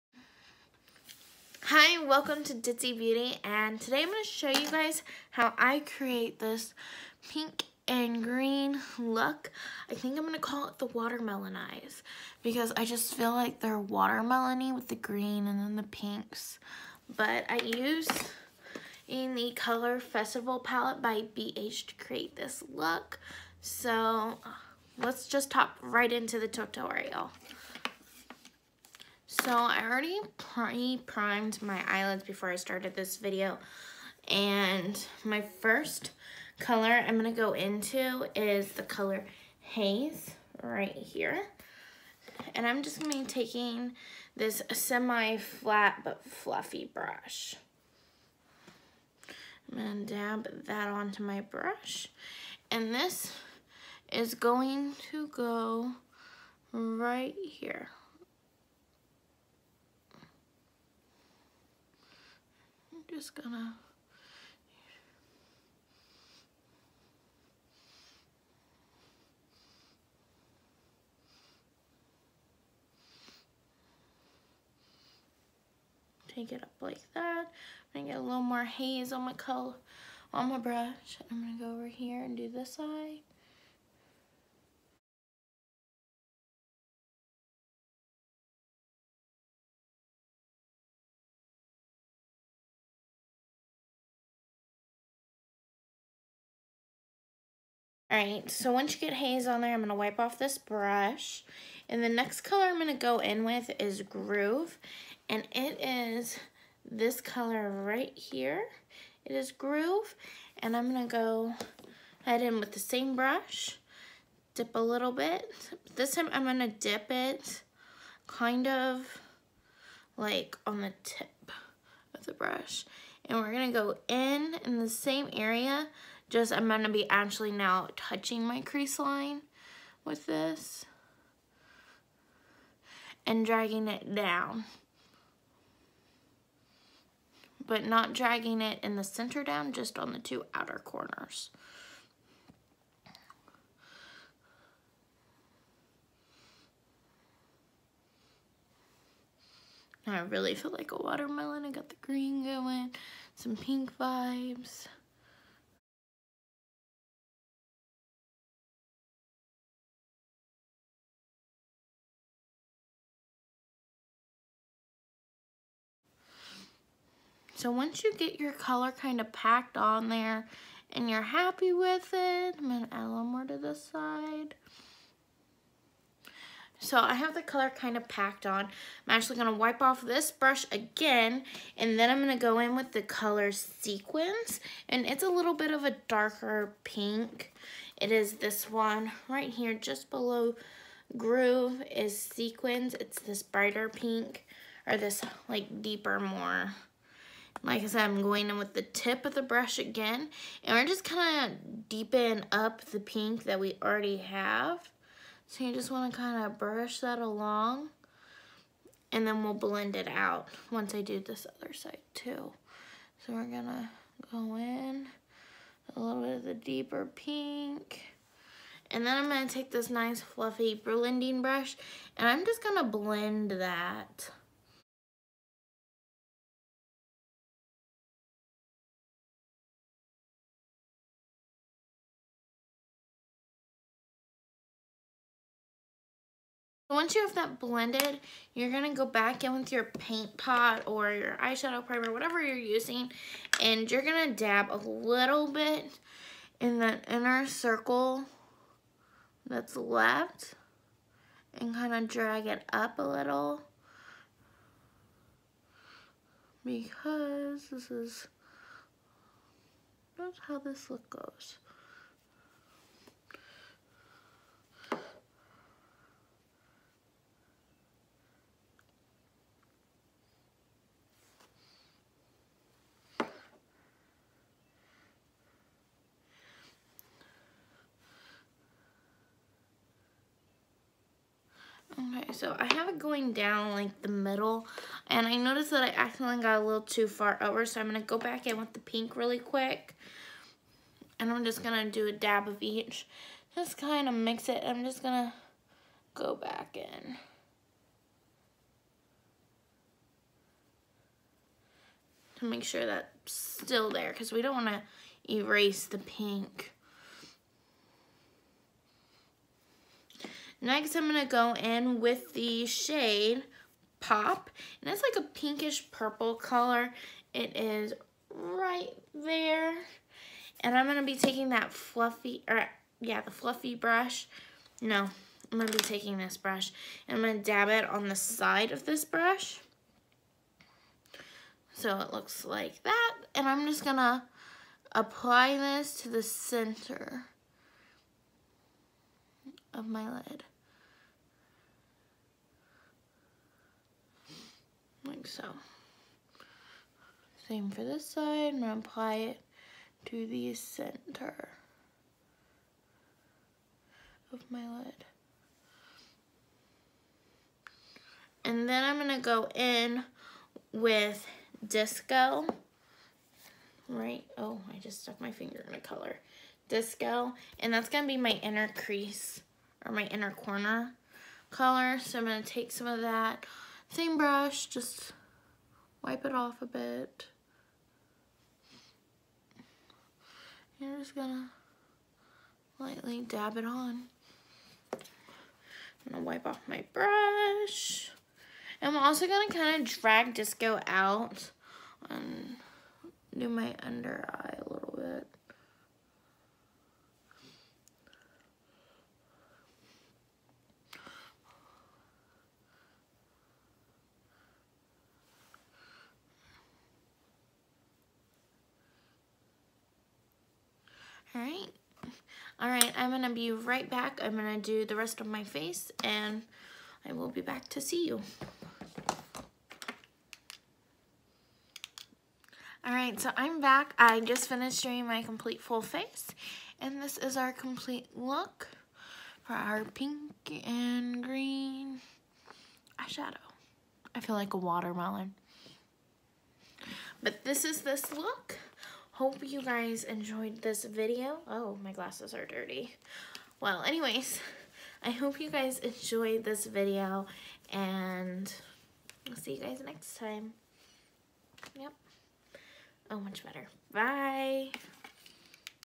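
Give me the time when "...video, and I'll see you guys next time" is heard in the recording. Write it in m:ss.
7:26.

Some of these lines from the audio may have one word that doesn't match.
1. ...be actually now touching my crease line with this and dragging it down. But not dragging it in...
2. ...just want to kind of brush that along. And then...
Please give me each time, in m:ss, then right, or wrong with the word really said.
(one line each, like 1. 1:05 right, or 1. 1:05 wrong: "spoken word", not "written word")
1. 2:06 right
2. 3:25 right.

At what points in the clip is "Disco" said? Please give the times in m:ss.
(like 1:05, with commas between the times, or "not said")
6:01, 6:06, 6:30.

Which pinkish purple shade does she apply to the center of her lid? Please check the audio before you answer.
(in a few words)
Pop.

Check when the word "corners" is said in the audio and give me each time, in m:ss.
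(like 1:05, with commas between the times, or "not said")
2:20, 6:10.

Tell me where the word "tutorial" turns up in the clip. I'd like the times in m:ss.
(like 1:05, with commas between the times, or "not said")
0:26.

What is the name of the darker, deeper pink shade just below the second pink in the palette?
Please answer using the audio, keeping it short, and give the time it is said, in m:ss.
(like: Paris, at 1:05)
Sequence, at 3:03.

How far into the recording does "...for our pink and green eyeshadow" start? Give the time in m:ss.
7:09.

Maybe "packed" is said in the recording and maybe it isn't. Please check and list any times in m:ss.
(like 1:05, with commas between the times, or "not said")
2:49, 2:58.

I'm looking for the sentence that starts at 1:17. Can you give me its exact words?
I'm gonna get a little more haze on my color on my brush.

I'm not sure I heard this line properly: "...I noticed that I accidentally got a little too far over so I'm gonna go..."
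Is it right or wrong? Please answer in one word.
right.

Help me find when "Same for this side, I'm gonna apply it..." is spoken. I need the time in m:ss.
5:47.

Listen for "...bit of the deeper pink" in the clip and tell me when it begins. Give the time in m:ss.
3:36.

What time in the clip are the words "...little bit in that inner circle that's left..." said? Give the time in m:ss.
4:04.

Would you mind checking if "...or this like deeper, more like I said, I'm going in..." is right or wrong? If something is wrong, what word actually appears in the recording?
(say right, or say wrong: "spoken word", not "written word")
right.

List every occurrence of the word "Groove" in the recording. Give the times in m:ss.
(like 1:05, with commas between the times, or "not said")
1:44, 1:49, 3:11.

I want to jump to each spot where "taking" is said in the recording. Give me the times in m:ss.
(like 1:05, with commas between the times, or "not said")
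0:43, 5:21, 5:25.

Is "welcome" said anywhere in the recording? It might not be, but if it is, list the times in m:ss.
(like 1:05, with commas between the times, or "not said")
0:02.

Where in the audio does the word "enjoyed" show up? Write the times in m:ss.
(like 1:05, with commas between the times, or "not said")
7:20, 7:25.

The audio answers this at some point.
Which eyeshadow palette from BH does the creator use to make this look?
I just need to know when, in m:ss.
0:19.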